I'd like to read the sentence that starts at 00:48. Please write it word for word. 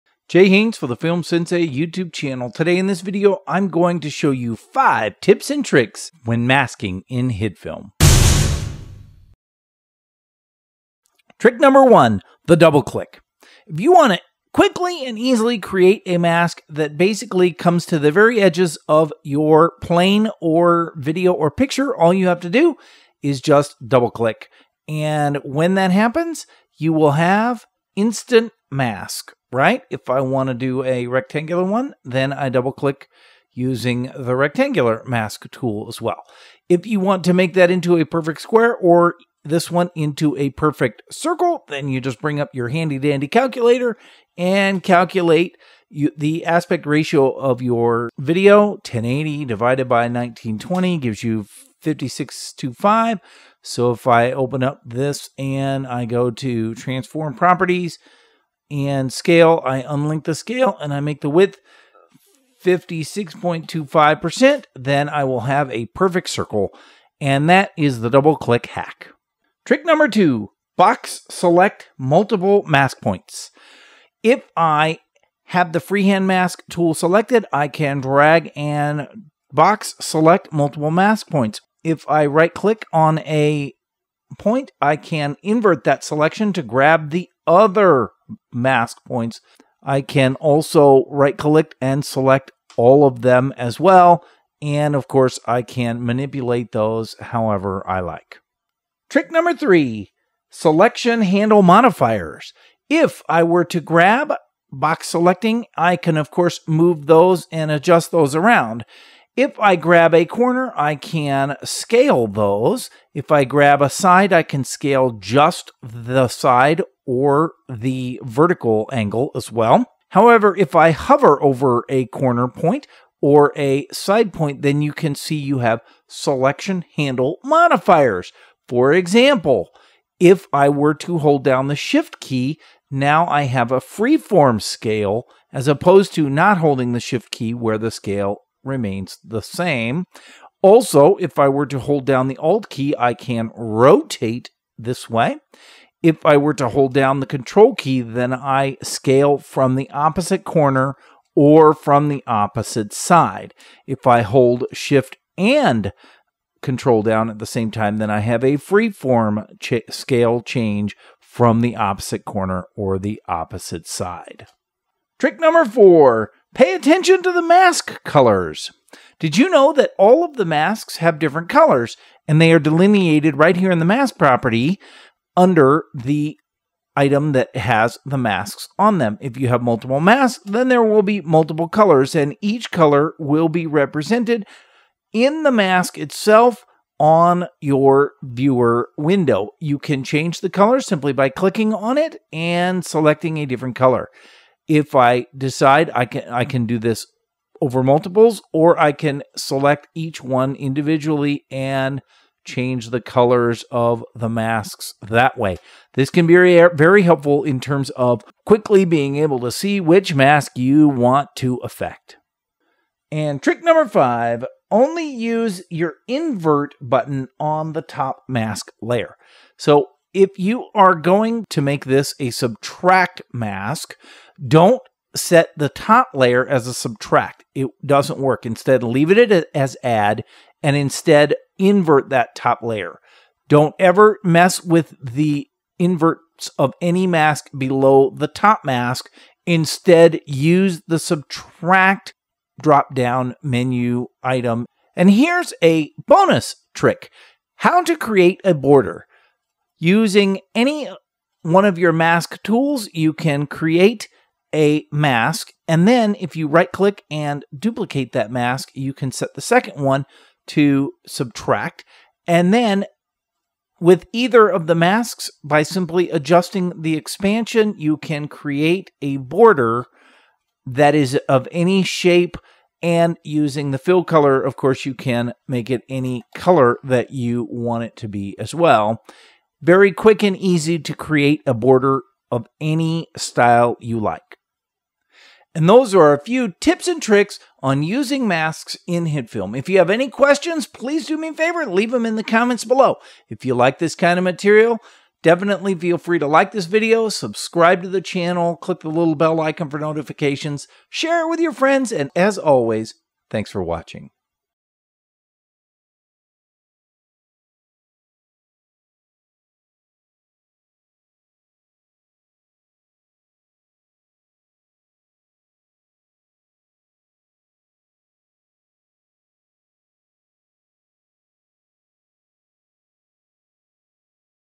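1080 divided by 1920 gives you 5625.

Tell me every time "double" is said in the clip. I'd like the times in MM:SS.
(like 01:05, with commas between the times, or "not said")
00:12, 00:23, 00:32, 01:08.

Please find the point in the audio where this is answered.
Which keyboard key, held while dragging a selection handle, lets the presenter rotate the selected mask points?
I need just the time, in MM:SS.
02:22.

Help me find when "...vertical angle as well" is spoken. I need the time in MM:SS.
01:58.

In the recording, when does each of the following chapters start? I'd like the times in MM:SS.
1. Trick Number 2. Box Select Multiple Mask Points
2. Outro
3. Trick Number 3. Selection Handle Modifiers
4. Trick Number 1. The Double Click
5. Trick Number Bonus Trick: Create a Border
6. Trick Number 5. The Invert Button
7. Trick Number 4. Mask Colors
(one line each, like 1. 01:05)
1. 01:09
2. 04:44
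3. 01:39
4. 00:11
5. 04:04
6. 03:32
7. 02:45.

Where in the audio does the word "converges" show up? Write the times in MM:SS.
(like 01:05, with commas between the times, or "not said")
not said.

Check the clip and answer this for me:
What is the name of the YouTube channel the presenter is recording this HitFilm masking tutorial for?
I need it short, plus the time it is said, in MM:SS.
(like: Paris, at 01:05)
Film Sensei, at 00:00.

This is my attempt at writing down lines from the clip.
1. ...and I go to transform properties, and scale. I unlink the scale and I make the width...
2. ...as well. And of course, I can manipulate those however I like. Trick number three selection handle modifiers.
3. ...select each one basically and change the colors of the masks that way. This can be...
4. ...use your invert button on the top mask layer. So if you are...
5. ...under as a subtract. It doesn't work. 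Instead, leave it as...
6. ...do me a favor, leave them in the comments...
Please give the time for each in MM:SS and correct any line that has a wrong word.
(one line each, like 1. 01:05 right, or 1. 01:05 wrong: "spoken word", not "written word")
1. 00:55 right
2. 01:33 right
3. 03:19 wrong: "individually", not "basically"
4. 03:35 right
5. 03:46 wrong: "layer", not "under"
6. 04:51 right.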